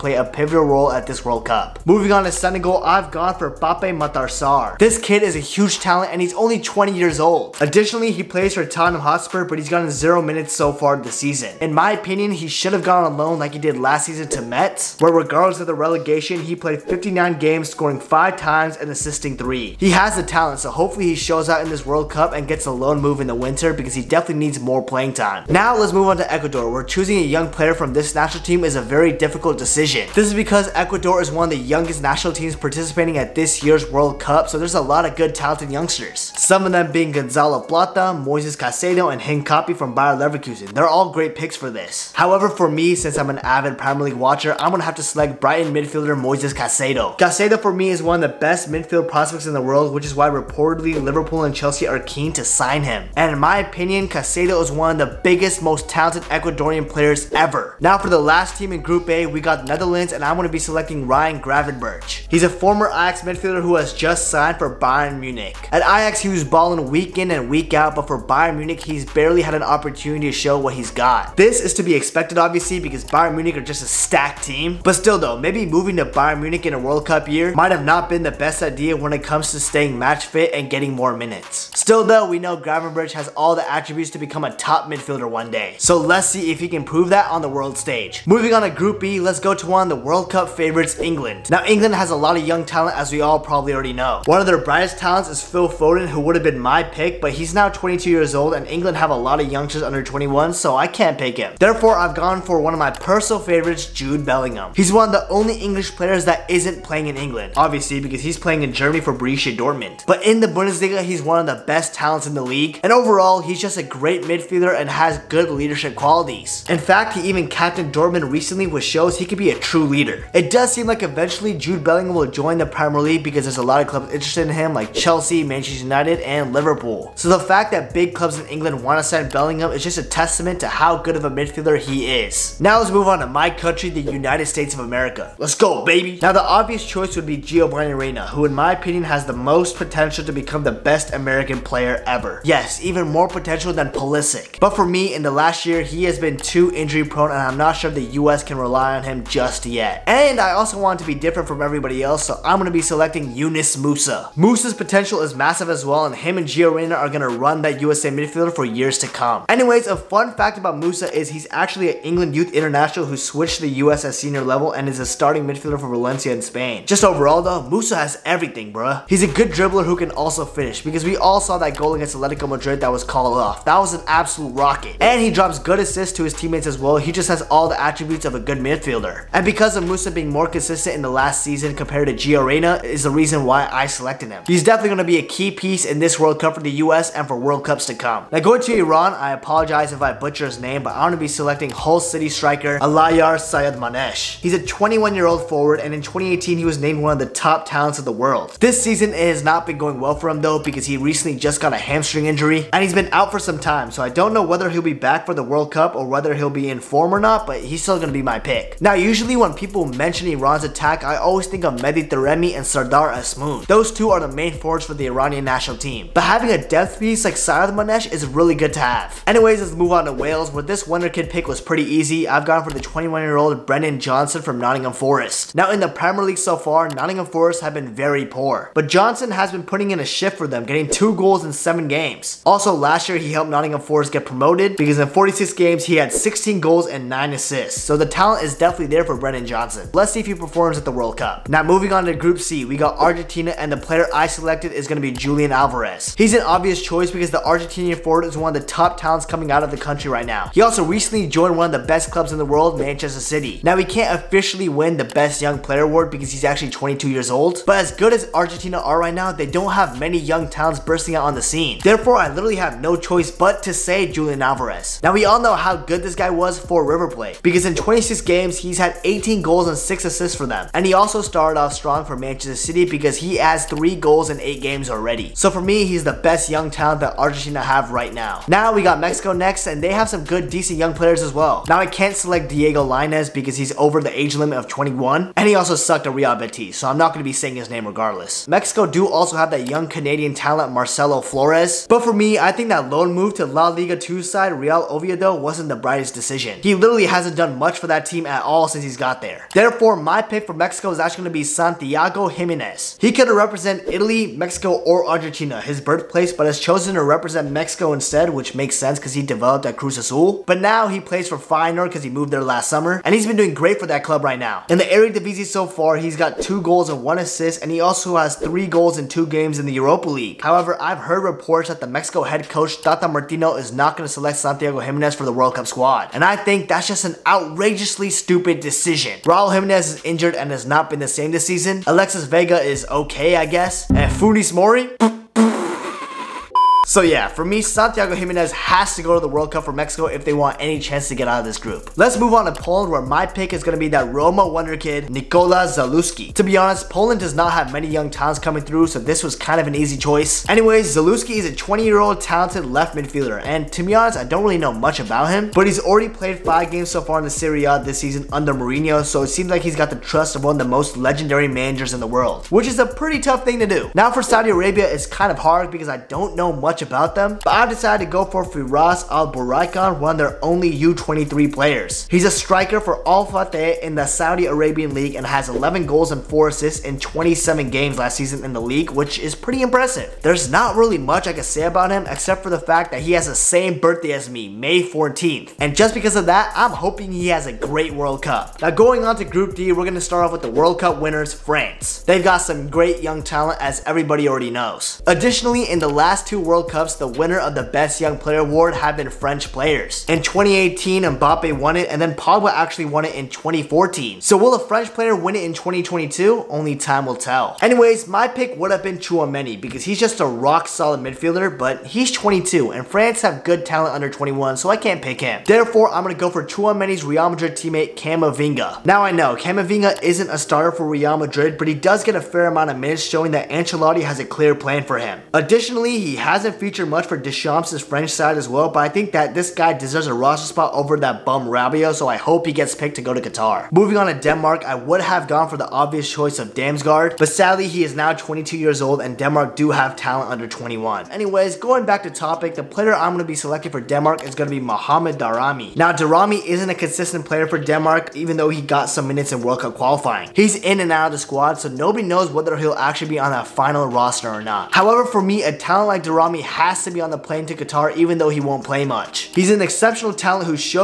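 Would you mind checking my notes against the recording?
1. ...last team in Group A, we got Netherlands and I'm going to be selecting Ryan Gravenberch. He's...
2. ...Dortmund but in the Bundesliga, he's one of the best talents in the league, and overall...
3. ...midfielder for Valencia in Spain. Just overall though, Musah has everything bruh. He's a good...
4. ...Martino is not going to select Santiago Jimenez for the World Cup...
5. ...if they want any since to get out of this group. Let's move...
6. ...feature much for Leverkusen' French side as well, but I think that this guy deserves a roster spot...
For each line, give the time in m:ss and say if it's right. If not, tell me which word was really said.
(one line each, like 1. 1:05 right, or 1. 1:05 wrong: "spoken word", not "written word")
1. 0:58 right
2. 1:49 right
3. 2:45 right
4. 5:23 right
5. 5:40 wrong: "chance", not "since"
6. 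7:06 wrong: "Deschamps", not "Leverkusen".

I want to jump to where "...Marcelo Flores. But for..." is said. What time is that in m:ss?
4:50.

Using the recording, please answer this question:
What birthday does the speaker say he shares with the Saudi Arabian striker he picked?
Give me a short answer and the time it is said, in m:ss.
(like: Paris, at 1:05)
May 14th, at 6:24.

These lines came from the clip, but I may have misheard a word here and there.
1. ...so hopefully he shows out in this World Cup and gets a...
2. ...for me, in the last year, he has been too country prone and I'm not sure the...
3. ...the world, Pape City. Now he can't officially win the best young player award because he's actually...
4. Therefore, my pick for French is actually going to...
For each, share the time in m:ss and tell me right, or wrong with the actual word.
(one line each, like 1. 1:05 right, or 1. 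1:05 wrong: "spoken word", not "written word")
1. 0:20 right
2. 2:24 wrong: "injury", not "country"
3. 4:12 wrong: "Manchester", not "Pape"
4. 4:59 wrong: "Mexico", not "French".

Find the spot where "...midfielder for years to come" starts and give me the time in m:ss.
2:38.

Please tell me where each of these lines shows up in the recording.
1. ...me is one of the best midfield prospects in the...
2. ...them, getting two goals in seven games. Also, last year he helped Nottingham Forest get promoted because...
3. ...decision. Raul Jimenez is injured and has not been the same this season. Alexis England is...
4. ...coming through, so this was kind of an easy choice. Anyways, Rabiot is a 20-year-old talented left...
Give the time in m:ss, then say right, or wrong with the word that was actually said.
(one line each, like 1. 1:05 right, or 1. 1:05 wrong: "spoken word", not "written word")
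1. 0:47 right
2. 3:50 right
3. 5:28 wrong: "Vega", not "England"
4. 5:48 wrong: "Zalewski", not "Rabiot".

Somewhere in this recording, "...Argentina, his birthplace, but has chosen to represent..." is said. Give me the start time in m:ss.
5:05.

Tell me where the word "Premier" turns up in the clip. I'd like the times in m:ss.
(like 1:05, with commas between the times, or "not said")
0:43, 2:02, 3:45.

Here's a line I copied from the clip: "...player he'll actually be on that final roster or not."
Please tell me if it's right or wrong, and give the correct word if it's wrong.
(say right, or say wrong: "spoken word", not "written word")
wrong: "whether", not "player".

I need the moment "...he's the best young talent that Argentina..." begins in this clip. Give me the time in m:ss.
4:35.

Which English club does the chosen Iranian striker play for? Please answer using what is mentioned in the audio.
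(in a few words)
Hull City.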